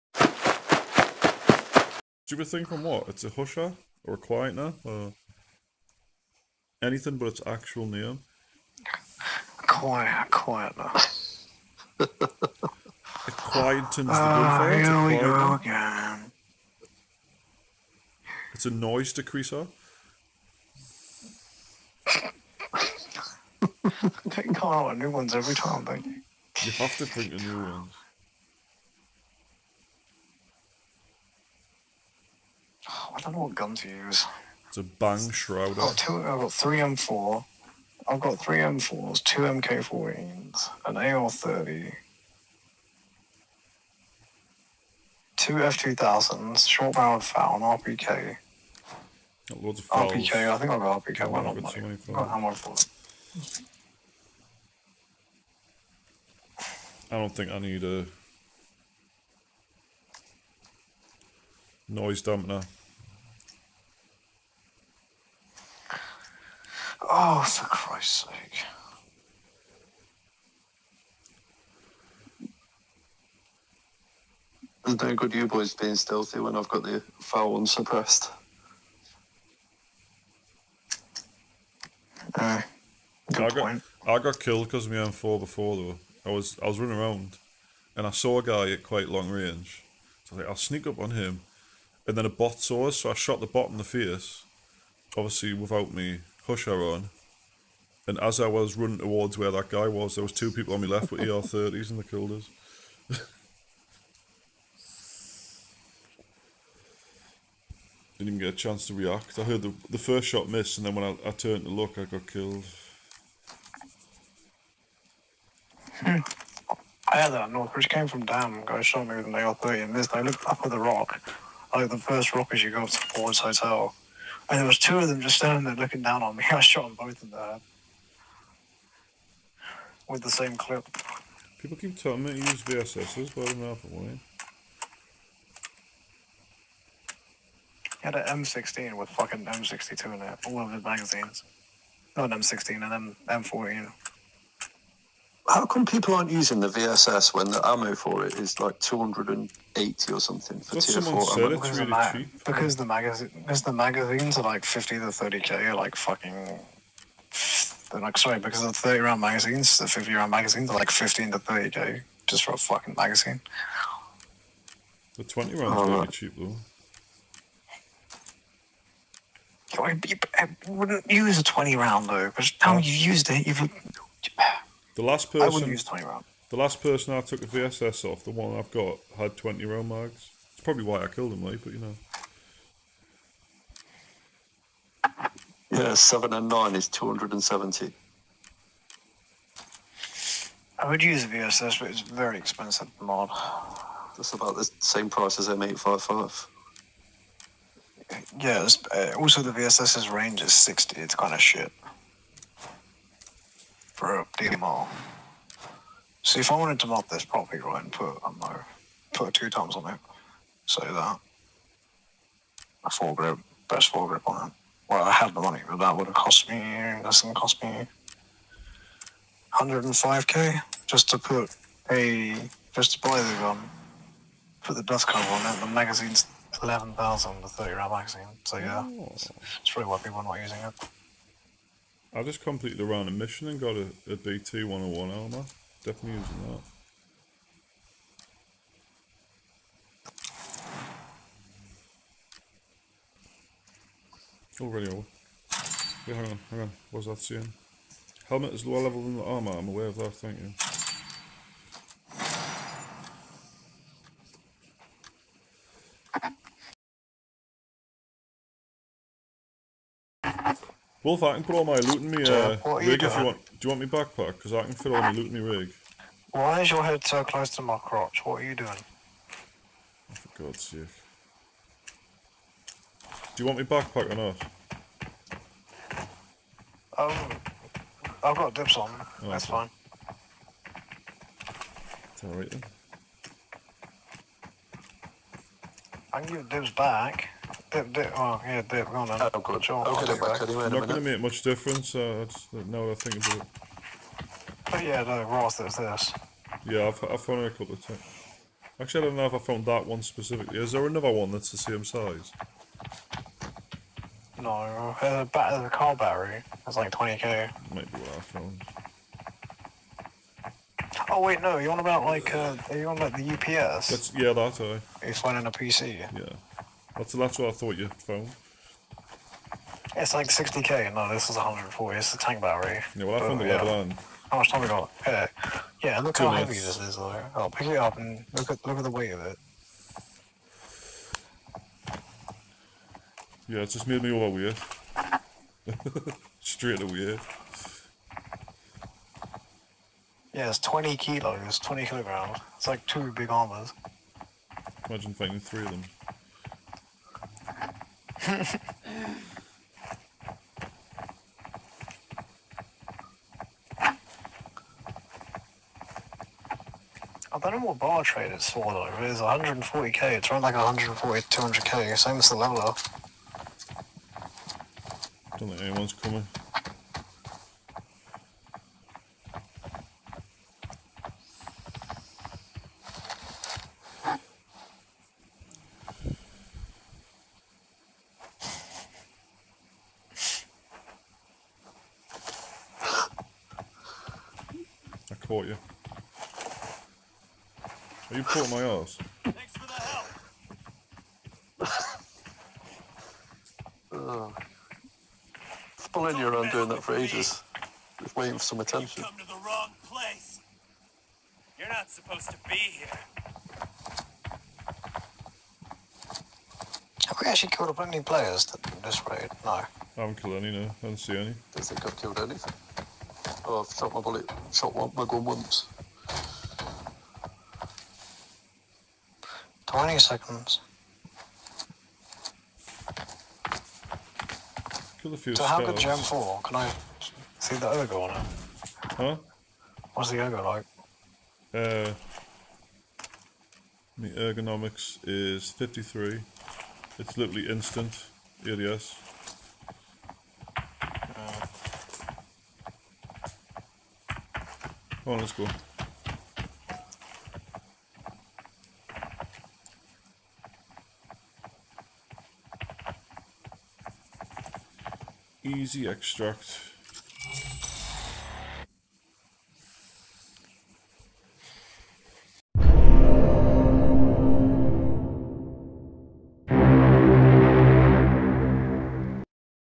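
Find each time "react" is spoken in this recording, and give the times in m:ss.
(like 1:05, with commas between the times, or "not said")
1:48.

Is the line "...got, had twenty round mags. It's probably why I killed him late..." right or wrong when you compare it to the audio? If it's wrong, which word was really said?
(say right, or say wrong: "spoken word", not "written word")
right.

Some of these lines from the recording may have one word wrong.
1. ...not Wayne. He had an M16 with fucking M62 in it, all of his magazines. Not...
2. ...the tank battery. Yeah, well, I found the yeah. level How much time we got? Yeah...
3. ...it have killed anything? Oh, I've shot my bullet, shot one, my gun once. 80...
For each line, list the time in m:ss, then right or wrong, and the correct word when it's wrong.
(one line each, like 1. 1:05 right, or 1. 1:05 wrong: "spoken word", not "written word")
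1. 2:13 right
2. 5:22 right
3. 6:51 wrong: "20", not "80".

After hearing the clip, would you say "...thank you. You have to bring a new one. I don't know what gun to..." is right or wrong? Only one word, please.
right.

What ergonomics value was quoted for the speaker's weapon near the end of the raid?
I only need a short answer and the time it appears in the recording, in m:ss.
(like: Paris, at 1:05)
53, at 7:15.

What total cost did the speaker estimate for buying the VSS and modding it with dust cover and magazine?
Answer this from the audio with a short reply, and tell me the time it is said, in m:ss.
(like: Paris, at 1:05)
105k, at 3:39.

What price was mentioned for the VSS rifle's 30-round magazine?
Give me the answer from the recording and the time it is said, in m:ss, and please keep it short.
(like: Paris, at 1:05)
11,000, at 3:46.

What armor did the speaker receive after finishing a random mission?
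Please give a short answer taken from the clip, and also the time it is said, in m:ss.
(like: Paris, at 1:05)
BT-101, at 3:54.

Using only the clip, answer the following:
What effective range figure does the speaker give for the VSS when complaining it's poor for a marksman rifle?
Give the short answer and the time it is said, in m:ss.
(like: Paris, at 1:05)
60, at 3:20.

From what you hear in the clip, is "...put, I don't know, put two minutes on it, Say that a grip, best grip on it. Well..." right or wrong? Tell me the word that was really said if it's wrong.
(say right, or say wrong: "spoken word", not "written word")
wrong: "times", not "minutes".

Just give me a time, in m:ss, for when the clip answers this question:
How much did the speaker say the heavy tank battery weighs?
5:41.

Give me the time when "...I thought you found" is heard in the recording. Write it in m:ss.
5:17.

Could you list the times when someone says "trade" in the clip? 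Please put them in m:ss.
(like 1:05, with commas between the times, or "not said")
5:58.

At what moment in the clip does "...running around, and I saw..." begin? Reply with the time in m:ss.
1:26.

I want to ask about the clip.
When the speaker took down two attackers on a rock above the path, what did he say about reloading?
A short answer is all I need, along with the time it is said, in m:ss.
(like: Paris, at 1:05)
same clip, at 2:10.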